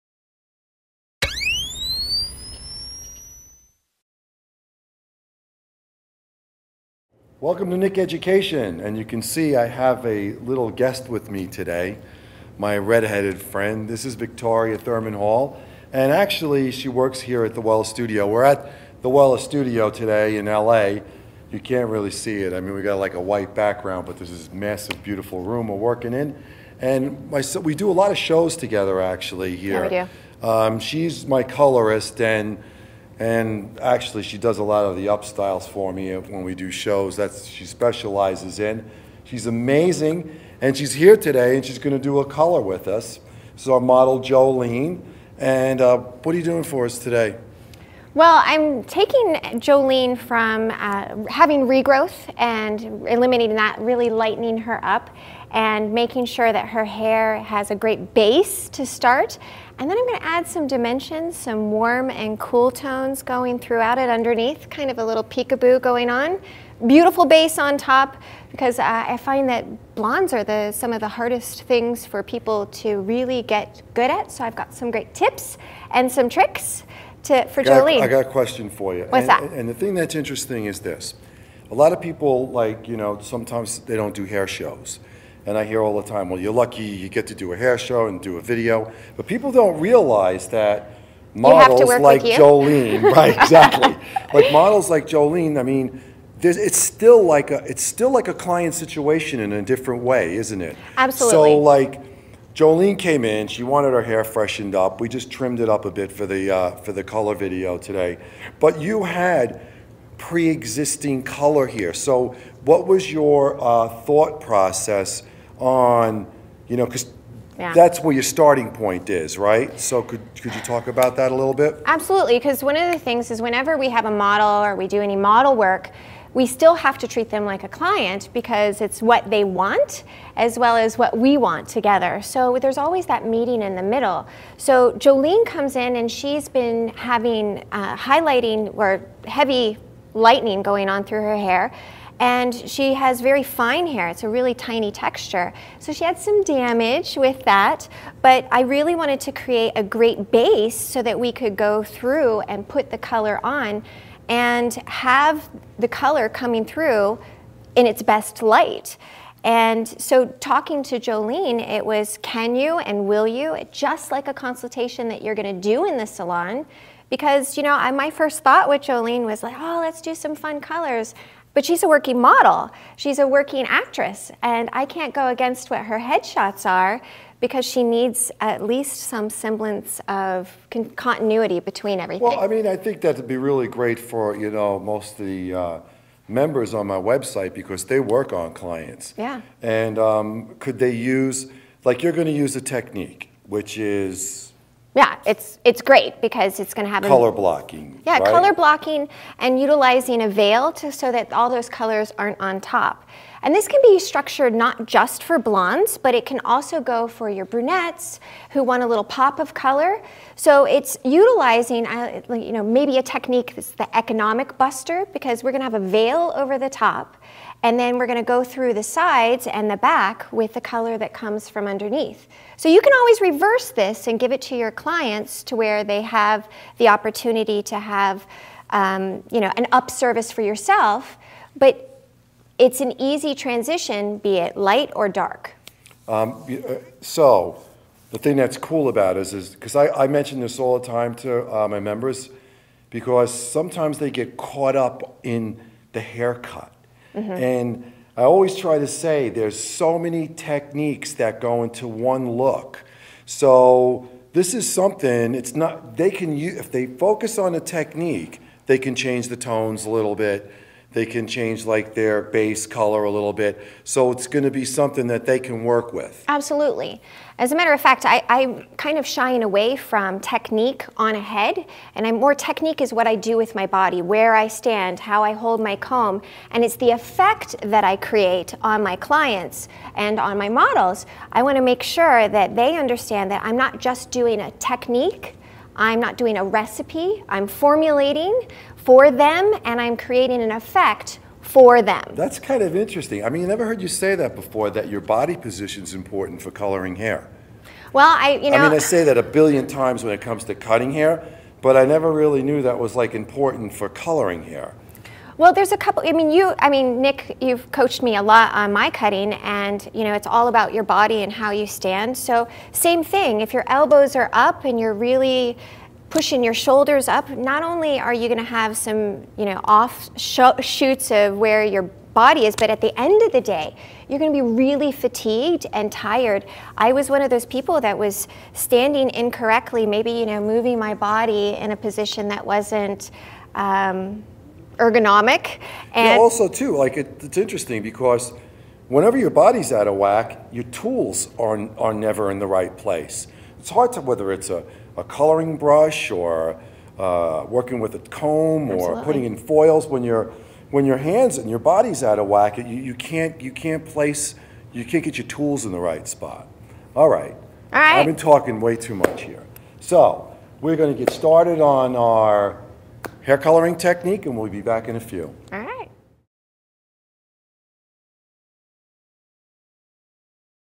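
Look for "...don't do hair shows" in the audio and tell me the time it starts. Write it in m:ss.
1:23.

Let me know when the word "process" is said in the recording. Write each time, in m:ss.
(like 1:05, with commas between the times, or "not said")
1:54.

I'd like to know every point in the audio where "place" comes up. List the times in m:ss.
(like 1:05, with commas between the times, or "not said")
5:42, 5:53.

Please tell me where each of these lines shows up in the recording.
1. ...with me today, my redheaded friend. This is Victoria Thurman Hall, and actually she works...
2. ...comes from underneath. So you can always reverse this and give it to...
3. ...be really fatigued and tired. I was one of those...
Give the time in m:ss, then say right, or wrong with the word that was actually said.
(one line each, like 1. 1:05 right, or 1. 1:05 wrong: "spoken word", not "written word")
1. 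0:11 right
2. 3:41 right
3. 5:24 right.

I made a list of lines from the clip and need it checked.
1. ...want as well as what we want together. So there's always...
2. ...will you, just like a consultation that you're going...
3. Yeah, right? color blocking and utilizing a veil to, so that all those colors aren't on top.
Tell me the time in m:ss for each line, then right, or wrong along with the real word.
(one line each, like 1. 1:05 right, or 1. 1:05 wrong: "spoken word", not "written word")
1. 2:09 right
2. 2:43 right
3. 3:18 right.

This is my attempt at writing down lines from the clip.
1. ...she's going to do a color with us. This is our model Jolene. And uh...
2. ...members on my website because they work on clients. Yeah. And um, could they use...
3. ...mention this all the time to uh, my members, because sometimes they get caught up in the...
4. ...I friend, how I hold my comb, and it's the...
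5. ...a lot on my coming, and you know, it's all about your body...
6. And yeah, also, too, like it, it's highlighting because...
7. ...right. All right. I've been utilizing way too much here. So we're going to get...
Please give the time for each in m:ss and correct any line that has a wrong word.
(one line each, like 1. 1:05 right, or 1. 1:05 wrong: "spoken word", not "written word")
1. 0:41 right
2. 3:06 right
3. 4:00 right
4. 4:34 wrong: "stand", not "friend"
5. 5:08 wrong: "cutting", not "coming"
6. 5:35 wrong: "interesting", not "highlighting"
7. 5:57 wrong: "talking", not "utilizing".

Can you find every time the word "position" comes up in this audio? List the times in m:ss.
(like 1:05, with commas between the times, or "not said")
4:55, 5:31.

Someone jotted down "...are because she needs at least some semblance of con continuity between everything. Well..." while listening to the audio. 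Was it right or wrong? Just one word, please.
right.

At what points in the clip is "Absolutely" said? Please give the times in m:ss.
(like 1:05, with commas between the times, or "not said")
1:40, 2:01, 4:26, 5:48.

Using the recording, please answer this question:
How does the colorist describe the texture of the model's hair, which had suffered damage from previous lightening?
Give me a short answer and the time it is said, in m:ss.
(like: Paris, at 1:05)
fine hair, at 2:23.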